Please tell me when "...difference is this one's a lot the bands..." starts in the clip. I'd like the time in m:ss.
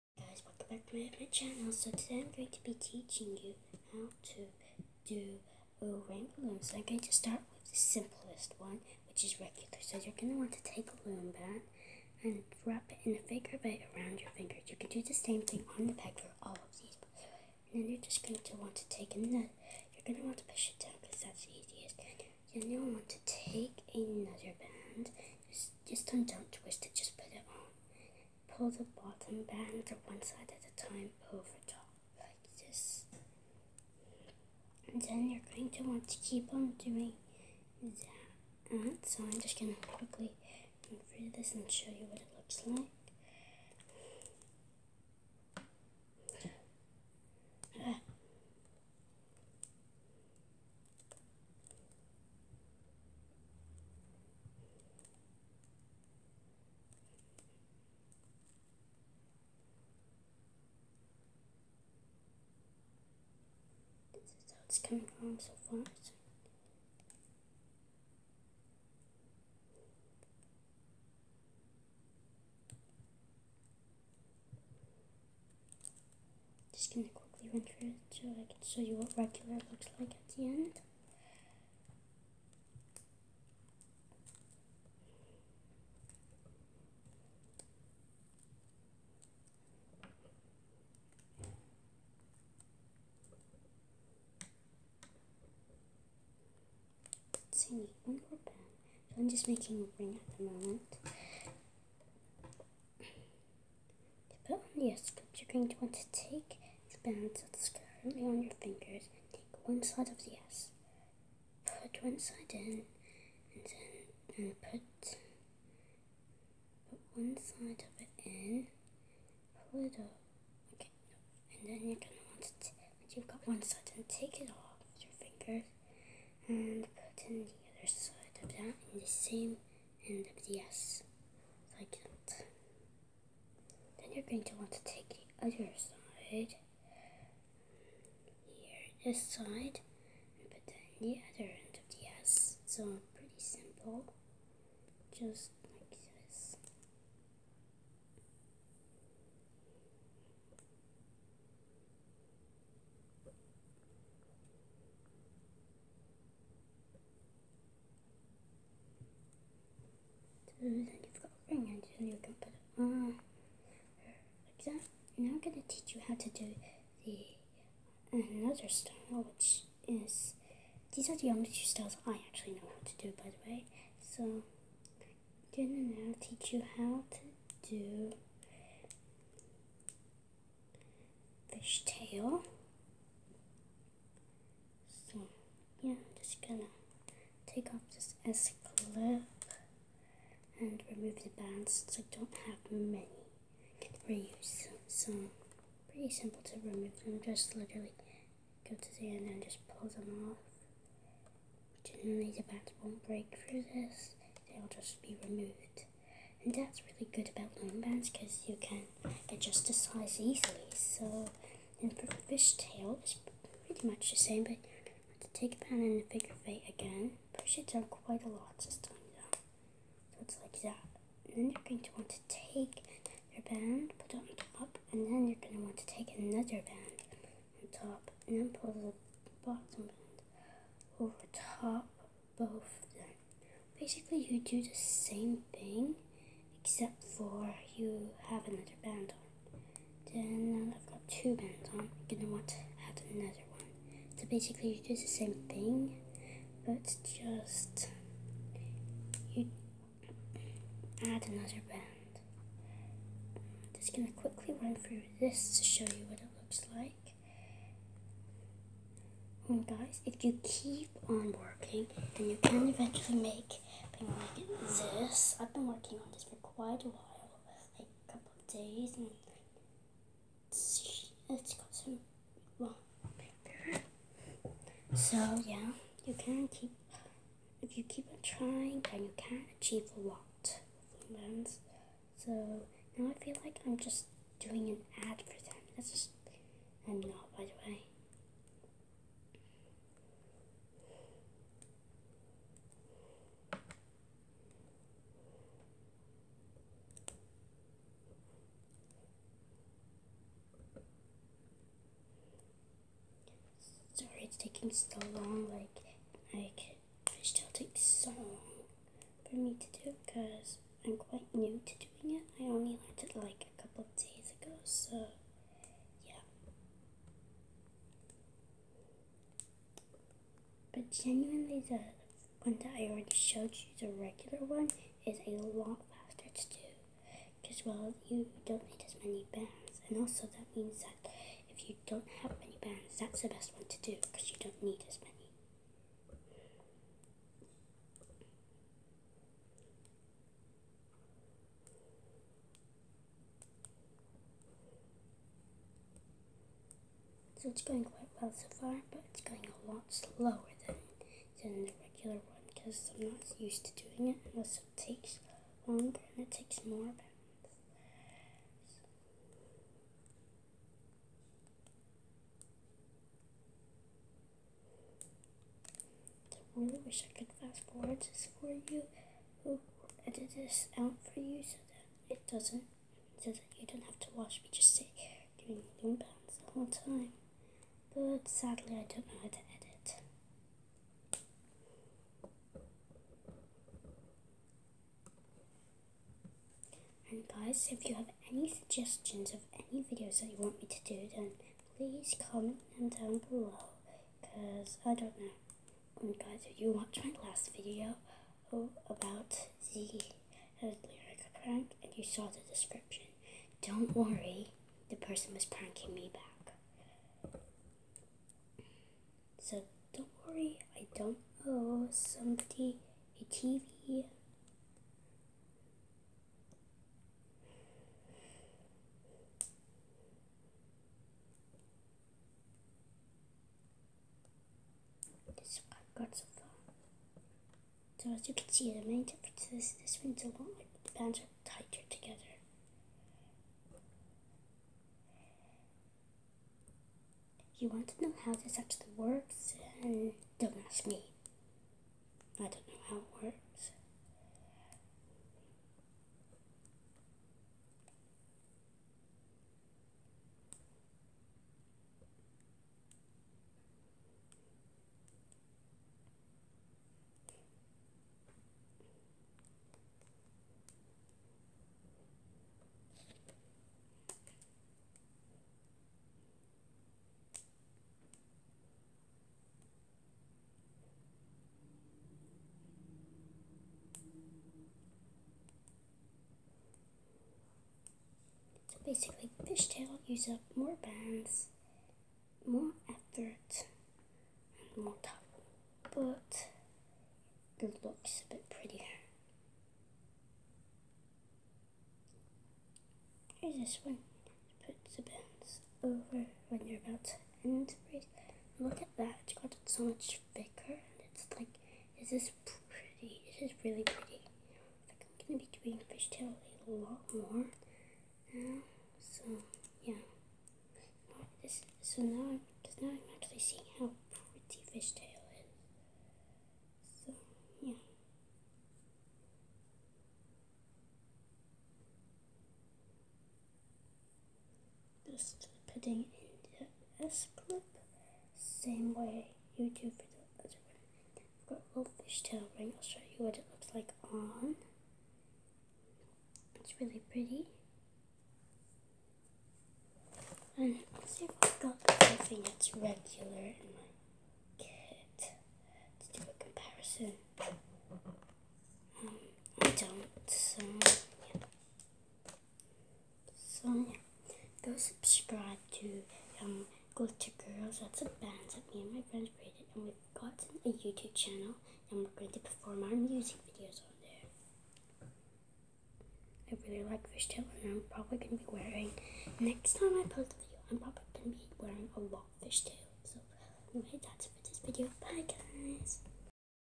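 7:09.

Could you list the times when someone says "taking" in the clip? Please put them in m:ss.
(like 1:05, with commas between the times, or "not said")
5:04.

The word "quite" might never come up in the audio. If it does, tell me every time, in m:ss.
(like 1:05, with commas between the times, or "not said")
3:37, 4:26, 5:10, 5:47.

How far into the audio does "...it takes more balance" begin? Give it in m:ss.
5:56.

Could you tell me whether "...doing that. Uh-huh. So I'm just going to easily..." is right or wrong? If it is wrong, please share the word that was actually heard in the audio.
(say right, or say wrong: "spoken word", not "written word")
wrong: "quickly", not "easily".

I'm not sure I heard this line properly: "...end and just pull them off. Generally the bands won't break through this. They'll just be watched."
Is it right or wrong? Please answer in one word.
wrong.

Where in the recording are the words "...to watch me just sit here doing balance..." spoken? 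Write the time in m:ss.
6:14.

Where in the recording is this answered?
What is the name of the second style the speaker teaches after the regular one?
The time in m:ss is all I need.
3:01.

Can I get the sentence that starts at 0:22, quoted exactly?
you will want to take another band.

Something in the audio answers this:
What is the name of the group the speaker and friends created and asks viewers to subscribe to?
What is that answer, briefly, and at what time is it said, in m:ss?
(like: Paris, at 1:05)
Glitter Girls, at 9:16.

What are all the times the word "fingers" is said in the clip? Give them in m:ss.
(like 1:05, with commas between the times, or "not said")
0:14, 1:48, 2:05.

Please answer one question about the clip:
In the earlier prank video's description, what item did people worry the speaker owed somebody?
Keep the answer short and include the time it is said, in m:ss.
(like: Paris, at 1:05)
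a TV, at 6:53.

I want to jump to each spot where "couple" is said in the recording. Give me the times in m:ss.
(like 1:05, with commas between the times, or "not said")
4:28, 5:13.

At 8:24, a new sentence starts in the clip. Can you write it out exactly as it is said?
I think I'm gonna be doing fishtail a lot more.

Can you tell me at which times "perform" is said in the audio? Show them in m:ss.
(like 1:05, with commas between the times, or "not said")
9:22.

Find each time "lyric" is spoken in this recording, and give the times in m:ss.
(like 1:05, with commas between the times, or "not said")
6:40.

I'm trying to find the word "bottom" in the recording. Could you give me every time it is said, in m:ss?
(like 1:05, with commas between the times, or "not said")
0:28, 3:49.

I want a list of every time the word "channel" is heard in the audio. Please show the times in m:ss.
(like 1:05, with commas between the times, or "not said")
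0:01, 9:21.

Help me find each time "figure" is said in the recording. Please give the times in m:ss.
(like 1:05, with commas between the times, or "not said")
0:13, 3:36.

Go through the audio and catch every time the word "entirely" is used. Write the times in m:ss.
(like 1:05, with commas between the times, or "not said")
not said.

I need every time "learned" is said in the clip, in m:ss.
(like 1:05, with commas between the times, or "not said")
5:12.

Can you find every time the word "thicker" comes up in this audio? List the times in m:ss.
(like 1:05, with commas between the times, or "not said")
8:20.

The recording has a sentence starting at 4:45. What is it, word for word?
That's just, I'm not by the way.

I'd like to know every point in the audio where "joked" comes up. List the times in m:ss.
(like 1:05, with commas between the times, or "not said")
not said.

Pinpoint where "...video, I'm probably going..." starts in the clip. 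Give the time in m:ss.
9:30.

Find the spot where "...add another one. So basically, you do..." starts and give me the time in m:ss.
4:02.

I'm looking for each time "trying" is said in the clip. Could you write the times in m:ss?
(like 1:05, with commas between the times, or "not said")
4:38.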